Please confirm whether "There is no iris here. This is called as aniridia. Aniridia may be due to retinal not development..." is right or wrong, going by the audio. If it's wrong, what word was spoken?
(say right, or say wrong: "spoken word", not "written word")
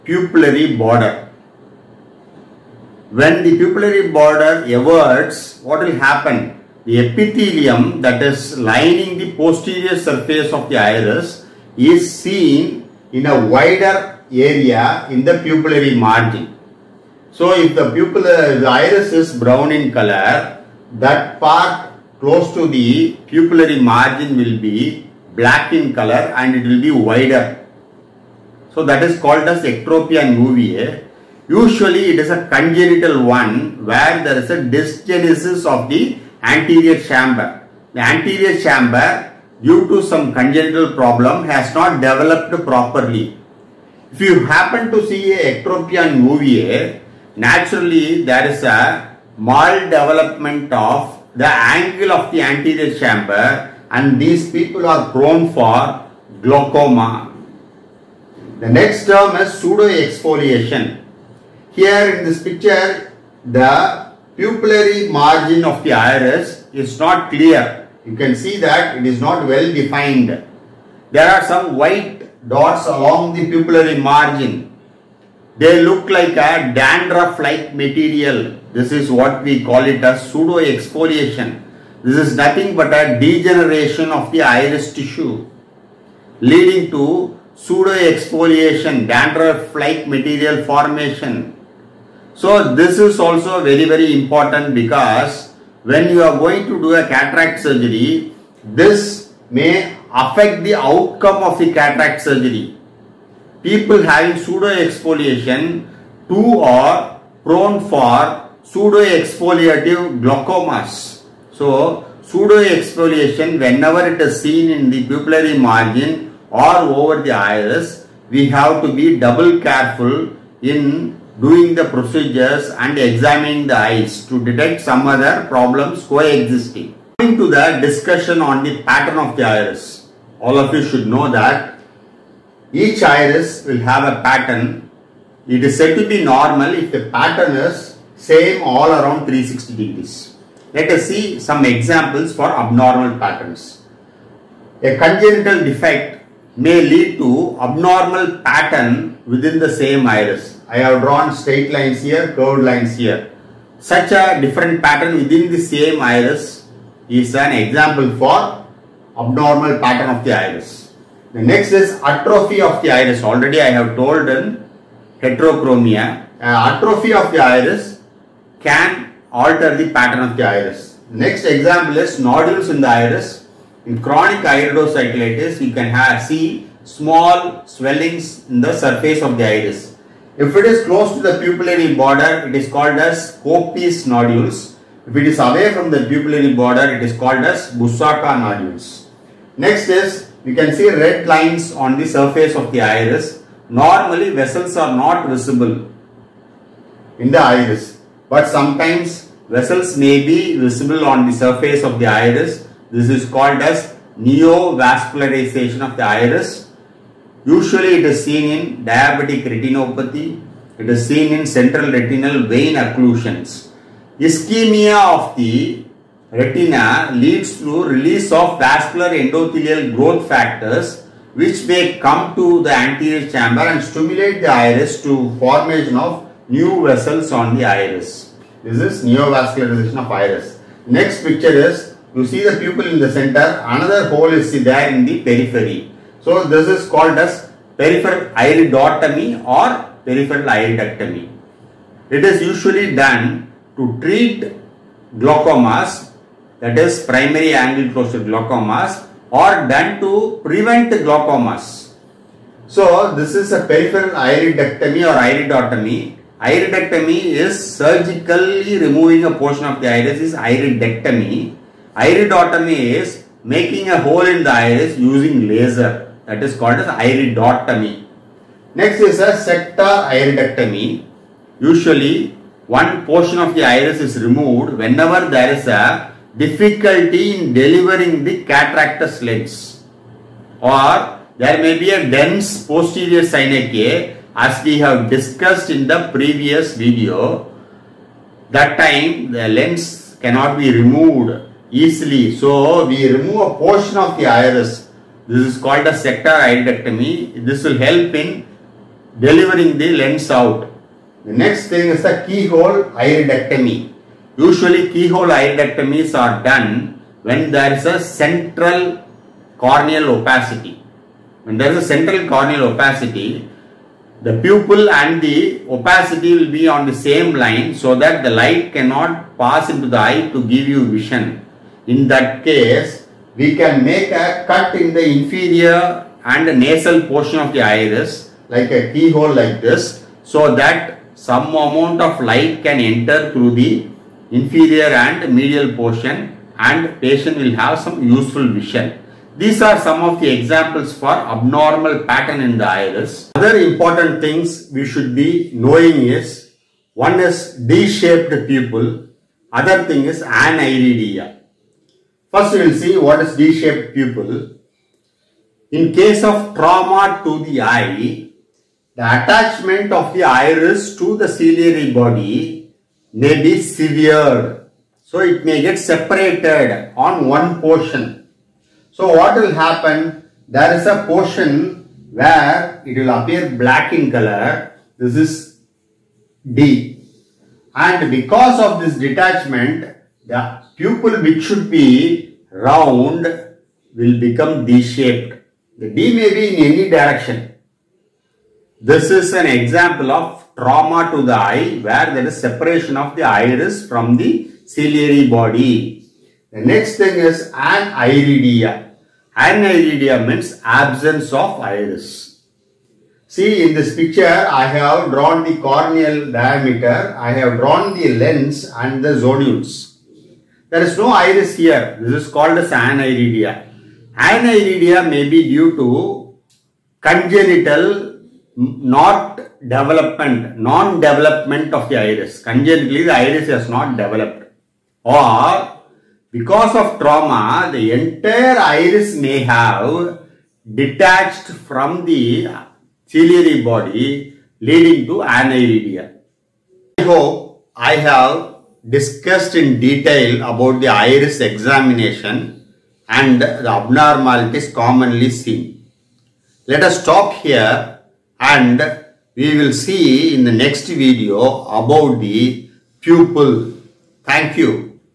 wrong: "congenital", not "retinal".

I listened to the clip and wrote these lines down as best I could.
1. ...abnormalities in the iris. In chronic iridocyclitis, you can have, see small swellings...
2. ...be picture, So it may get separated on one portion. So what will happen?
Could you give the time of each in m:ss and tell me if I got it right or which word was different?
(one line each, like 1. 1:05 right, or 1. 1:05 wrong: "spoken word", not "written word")
1. 2:52 wrong: "nodules", not "abnormalities"
2. 6:03 wrong: "severe", not "picture".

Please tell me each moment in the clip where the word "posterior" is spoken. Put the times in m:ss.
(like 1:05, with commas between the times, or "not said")
0:09, 4:42.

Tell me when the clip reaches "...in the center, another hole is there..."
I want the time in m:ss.
3:52.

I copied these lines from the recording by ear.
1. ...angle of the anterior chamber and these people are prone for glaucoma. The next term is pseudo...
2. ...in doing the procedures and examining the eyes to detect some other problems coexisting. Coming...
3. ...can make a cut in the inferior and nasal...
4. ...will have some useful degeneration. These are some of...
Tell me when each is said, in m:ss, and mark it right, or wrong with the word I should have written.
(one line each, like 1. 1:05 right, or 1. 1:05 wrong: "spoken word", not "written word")
1. 0:51 right
2. 2:00 right
3. 5:23 right
4. 5:37 wrong: "vision", not "degeneration".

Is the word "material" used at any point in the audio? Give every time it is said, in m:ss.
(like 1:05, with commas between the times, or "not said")
1:17, 1:30.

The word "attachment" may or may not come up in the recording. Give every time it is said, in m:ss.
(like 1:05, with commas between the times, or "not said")
5:59.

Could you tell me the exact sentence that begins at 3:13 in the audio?
Normally, vessels are not visible in the iris, but sometimes vessels may be visible on the surface of the iris.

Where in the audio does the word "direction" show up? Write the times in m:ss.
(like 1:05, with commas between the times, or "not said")
6:26.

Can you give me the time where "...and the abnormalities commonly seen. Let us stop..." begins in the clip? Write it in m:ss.
7:23.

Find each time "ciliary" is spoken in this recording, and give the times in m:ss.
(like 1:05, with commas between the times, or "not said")
4:43, 6:01, 6:34, 7:13.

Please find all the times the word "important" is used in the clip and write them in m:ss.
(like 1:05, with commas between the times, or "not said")
1:34, 5:43.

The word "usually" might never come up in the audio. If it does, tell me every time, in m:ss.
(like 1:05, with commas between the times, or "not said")
0:31, 3:27, 4:02, 4:31, 5:04.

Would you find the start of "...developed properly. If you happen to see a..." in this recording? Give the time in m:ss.
0:41.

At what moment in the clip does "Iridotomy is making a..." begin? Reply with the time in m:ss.
4:21.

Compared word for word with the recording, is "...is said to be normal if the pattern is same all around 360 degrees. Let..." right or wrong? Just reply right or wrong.
right.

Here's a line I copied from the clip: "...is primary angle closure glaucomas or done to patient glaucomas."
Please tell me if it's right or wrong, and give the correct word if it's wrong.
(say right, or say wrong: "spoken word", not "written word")
wrong: "prevent", not "patient".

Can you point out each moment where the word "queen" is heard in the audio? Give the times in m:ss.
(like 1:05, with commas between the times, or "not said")
not said.